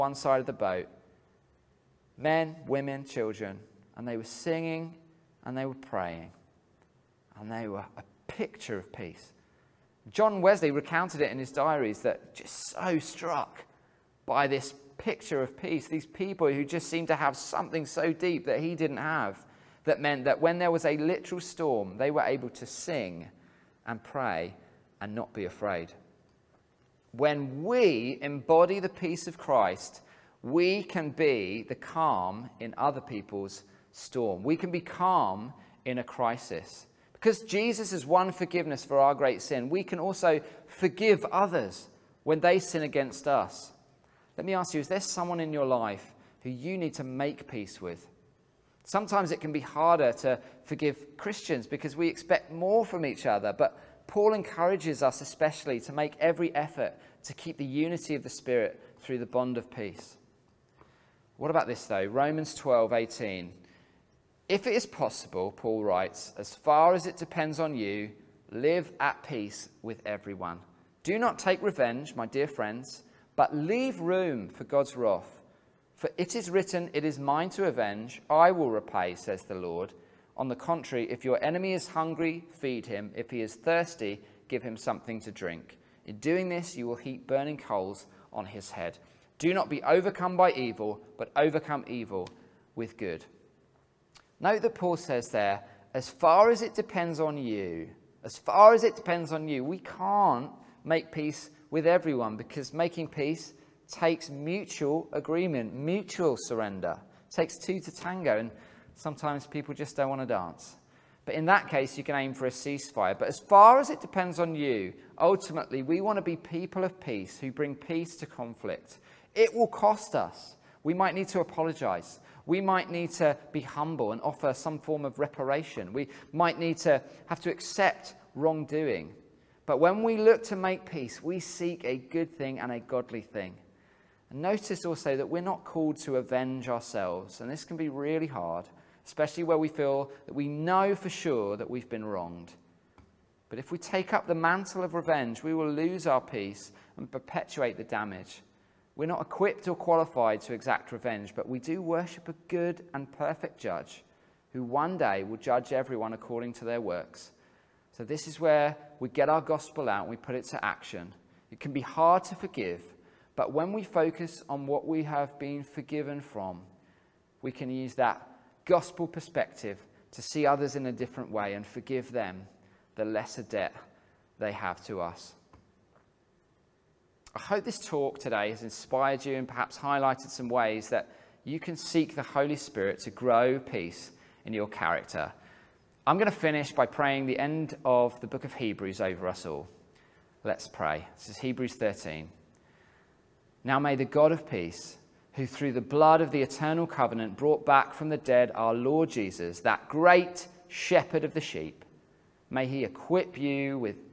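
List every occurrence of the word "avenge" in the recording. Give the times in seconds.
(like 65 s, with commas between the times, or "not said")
77 s, 136 s.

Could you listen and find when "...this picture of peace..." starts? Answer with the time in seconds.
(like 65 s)
14 s.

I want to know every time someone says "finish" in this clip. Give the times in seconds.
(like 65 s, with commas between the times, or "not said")
186 s.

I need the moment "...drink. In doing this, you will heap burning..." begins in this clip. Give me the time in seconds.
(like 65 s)
85 s.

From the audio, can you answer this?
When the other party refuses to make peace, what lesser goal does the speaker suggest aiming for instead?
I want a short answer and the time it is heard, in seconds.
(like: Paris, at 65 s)
A ceasefire, at 112 s.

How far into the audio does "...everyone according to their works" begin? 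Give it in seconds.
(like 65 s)
155 s.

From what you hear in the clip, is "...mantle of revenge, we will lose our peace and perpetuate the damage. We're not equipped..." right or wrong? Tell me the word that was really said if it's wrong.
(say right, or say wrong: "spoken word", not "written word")
right.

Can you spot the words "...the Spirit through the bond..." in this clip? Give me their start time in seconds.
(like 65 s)
58 s.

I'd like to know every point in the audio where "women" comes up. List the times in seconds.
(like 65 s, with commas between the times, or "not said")
2 s.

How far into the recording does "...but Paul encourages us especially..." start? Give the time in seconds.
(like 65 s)
53 s.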